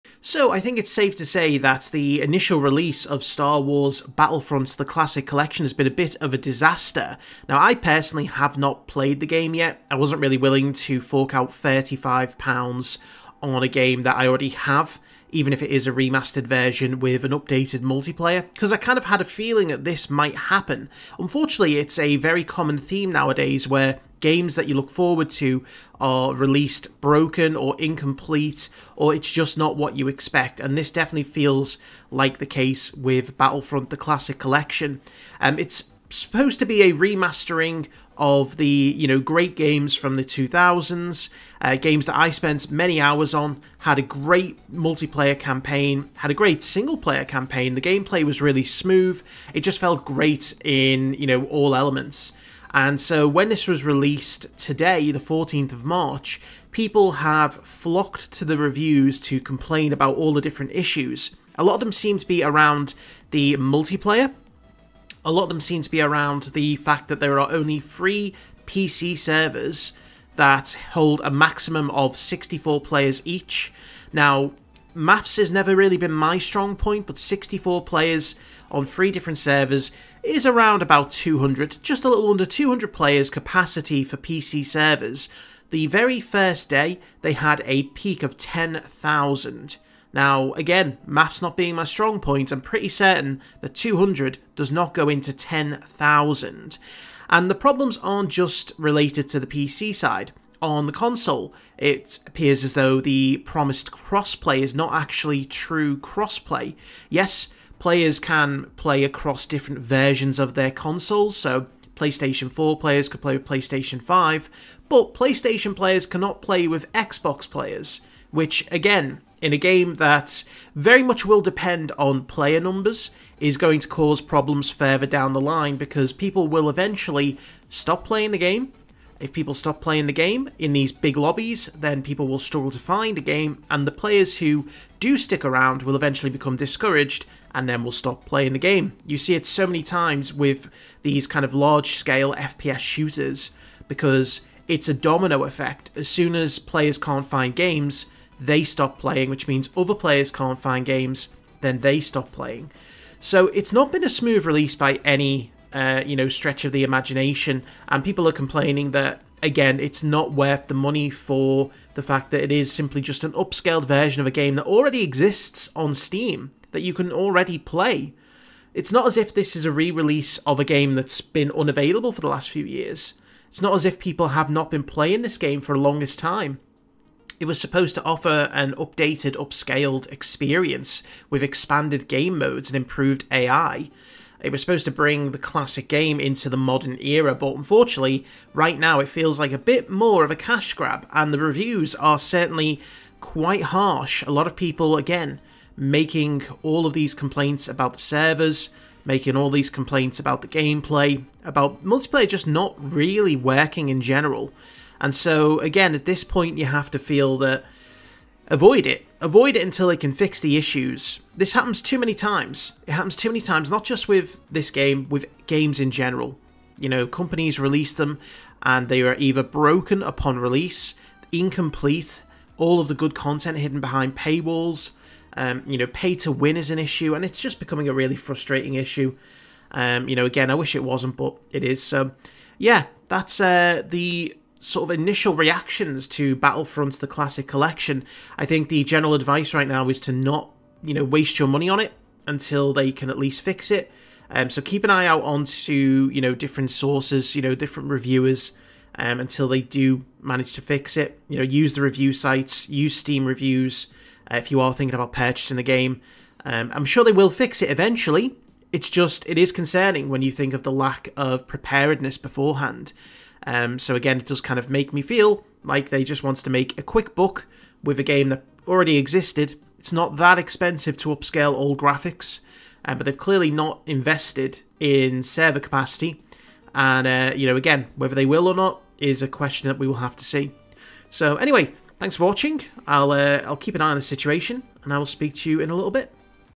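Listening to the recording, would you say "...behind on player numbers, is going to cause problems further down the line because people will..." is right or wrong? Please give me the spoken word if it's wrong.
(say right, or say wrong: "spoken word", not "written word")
wrong: "depend", not "behind".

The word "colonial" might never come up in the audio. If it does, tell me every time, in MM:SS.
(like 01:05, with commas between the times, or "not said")
not said.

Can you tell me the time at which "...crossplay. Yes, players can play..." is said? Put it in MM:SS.
01:45.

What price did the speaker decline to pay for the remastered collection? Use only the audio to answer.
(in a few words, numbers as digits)
£35.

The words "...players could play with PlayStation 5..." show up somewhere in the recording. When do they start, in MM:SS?
01:52.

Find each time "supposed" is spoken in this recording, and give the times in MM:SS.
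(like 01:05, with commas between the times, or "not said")
00:36, 02:57, 03:04.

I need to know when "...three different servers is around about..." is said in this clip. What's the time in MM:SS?
01:18.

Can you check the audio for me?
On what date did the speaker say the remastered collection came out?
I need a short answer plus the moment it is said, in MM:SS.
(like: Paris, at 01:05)
14th of March, at 00:55.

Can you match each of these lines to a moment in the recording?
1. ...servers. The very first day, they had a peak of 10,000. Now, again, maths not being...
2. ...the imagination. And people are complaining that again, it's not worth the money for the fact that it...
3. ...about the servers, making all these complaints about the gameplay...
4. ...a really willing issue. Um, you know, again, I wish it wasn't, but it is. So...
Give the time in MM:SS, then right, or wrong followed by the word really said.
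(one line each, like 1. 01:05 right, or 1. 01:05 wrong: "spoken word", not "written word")
1. 01:24 right
2. 02:36 right
3. 03:17 right
4. 03:47 wrong: "frustrating", not "willing".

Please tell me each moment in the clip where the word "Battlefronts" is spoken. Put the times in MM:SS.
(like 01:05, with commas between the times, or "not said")
00:04, 00:33, 03:56.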